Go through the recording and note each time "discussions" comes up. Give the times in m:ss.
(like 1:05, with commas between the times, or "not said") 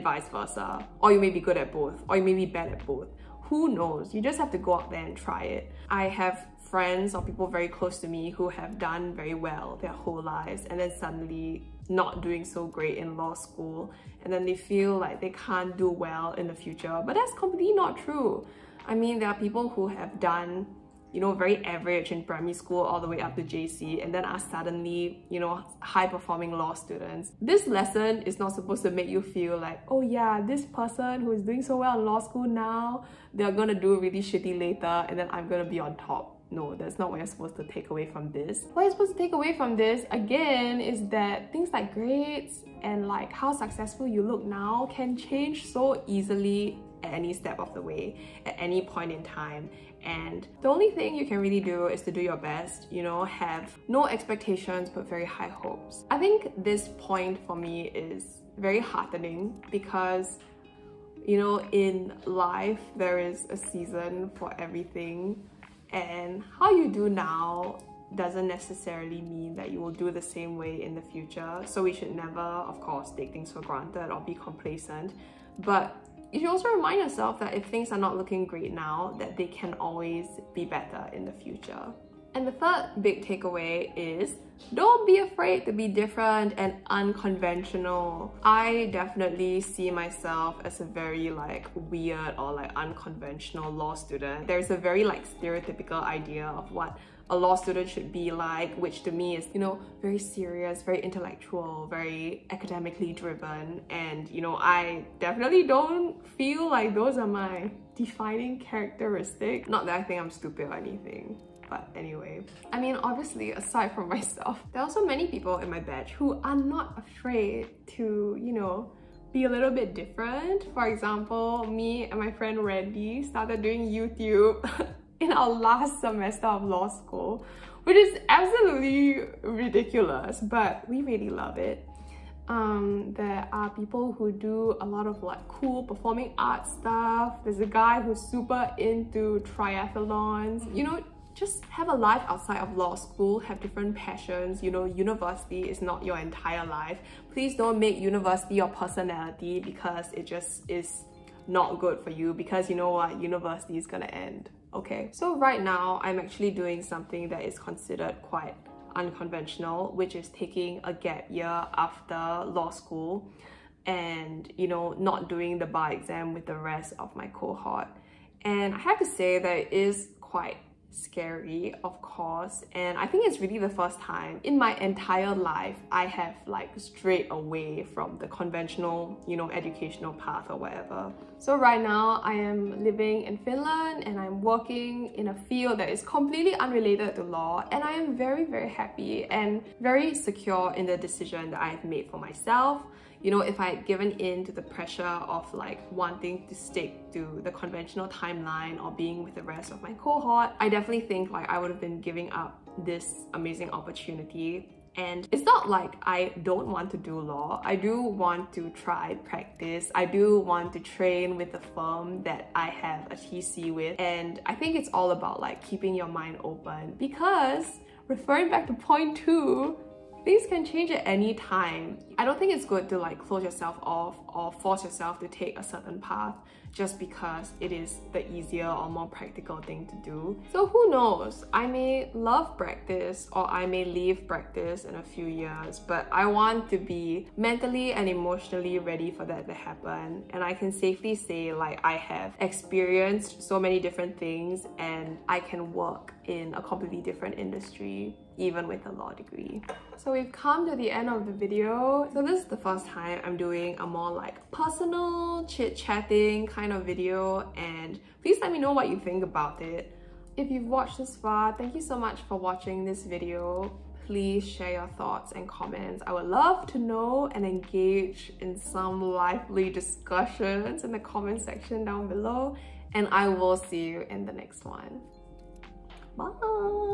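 4:29.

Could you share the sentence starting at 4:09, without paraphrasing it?
So we've come to the end of the video.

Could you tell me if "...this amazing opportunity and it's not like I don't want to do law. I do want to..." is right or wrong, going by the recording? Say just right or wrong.
right.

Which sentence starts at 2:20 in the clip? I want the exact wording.
You know, just have a life outside of law school, have different passions.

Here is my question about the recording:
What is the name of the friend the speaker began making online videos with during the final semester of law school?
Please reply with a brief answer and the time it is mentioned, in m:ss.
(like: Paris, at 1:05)
Randy, at 2:02.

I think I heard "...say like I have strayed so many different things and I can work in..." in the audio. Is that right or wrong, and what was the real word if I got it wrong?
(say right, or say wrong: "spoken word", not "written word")
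wrong: "experienced", not "strayed".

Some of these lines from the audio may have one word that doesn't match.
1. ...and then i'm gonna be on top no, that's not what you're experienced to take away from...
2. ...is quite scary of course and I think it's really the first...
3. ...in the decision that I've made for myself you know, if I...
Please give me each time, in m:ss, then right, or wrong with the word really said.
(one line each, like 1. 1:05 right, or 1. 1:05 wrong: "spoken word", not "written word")
1. 0:35 wrong: "supposed", not "experienced"
2. 2:49 right
3. 3:10 right.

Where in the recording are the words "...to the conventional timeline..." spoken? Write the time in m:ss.
3:17.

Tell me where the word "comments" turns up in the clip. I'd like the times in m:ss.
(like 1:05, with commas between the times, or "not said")
4:25, 4:30.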